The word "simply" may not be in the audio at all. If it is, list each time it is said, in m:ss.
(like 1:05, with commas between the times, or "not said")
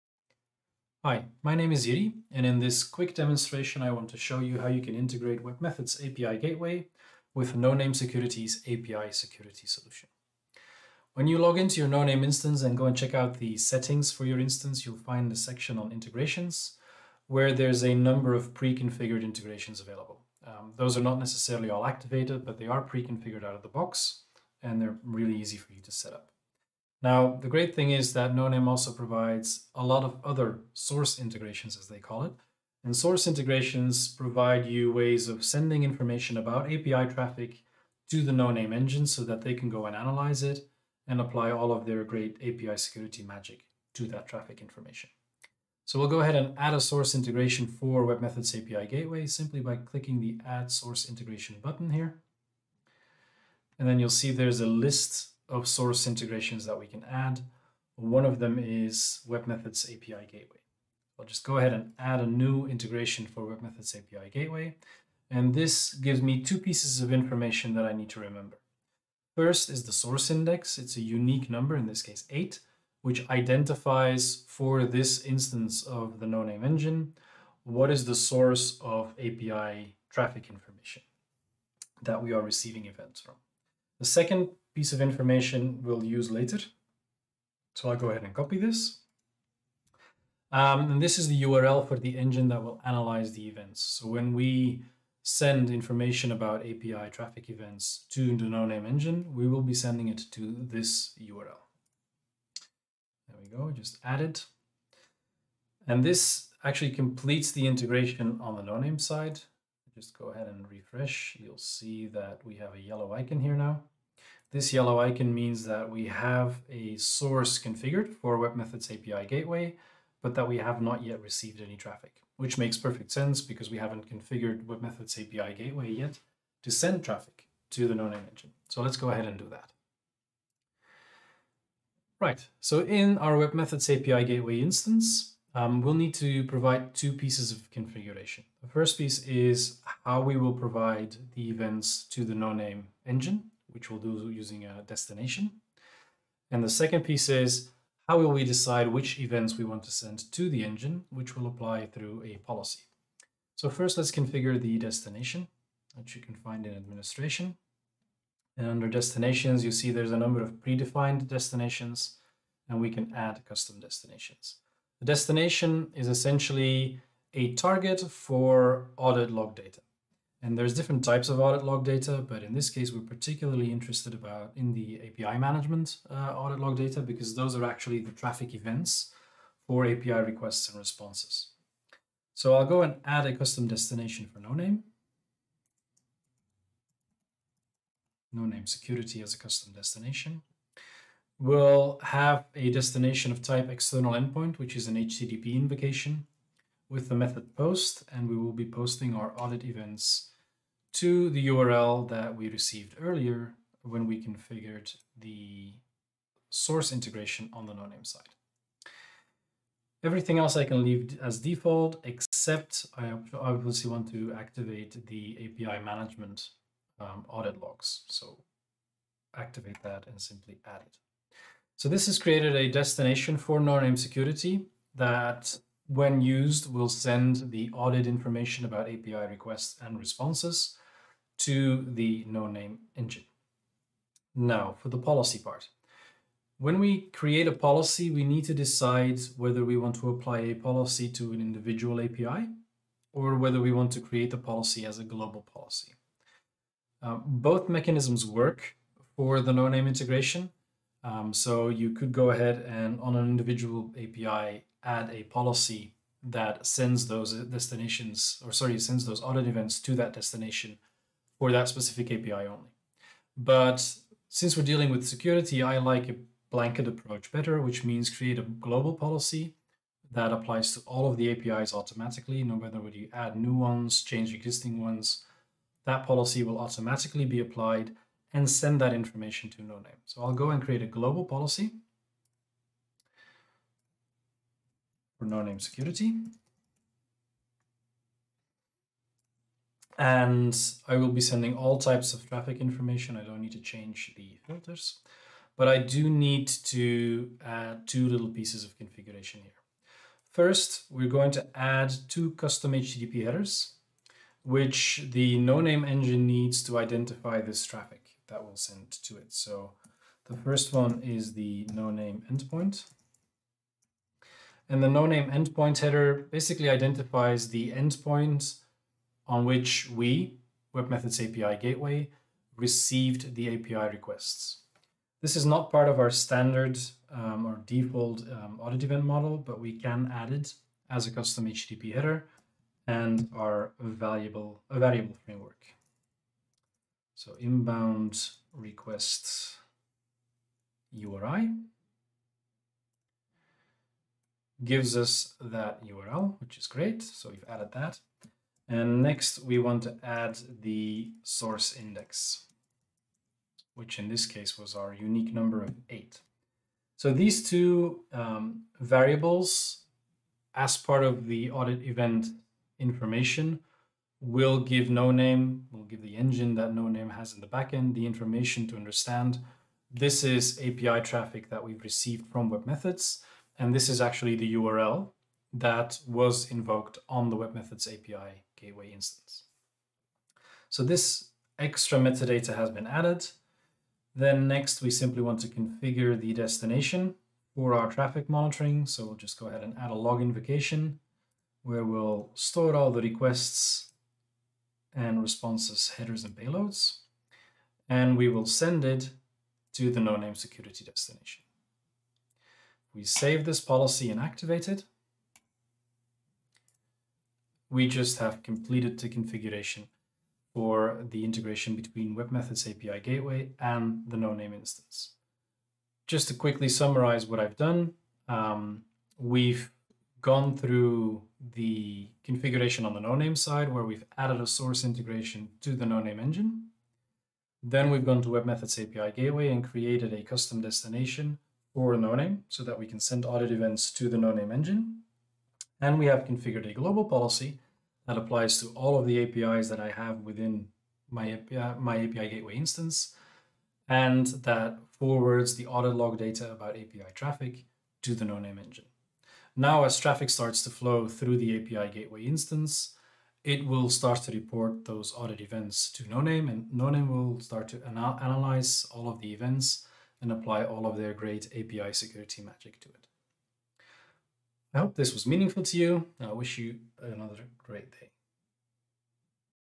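0:49, 3:40, 6:24.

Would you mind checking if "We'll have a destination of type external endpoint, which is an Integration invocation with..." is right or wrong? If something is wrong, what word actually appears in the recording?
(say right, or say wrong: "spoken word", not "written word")
wrong: "HTTP", not "Integration".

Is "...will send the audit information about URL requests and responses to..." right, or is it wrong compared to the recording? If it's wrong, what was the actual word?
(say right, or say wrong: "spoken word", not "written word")
wrong: "API", not "URL".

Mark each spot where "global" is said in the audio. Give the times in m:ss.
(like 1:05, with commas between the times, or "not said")
4:05, 4:28, 4:40, 7:16.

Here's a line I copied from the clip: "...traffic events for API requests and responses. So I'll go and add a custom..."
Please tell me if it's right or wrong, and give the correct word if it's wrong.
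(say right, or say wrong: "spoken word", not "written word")
right.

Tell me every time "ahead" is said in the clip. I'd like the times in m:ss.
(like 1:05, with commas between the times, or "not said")
0:46, 1:01, 1:28, 1:50, 2:09, 4:12, 6:29.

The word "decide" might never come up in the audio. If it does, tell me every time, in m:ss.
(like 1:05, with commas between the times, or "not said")
2:28, 3:58.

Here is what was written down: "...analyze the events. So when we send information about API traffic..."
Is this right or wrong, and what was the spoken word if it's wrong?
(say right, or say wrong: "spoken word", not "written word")
right.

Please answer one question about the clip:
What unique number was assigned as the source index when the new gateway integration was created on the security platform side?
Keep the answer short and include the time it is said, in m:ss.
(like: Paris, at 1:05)
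8, at 1:11.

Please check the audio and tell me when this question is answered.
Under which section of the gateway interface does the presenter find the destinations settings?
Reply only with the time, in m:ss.
2:36.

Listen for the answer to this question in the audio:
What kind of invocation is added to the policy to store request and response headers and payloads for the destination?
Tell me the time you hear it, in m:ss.
6:29.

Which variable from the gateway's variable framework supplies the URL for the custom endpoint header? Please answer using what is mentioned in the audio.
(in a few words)
Inbound request URI.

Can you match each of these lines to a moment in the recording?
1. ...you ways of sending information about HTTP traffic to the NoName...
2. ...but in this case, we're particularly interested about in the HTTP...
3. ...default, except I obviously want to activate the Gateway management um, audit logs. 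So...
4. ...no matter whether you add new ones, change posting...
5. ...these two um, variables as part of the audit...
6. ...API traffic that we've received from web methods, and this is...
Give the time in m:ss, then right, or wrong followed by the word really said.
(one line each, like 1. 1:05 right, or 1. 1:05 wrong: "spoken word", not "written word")
1. 0:34 wrong: "API", not "HTTP"
2. 2:52 wrong: "API", not "HTTP"
3. 3:31 wrong: "API", not "Gateway"
4. 4:32 wrong: "existing", not "posting"
5. 5:57 right
6. 6:10 right.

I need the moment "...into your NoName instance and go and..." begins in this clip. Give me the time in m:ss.
0:11.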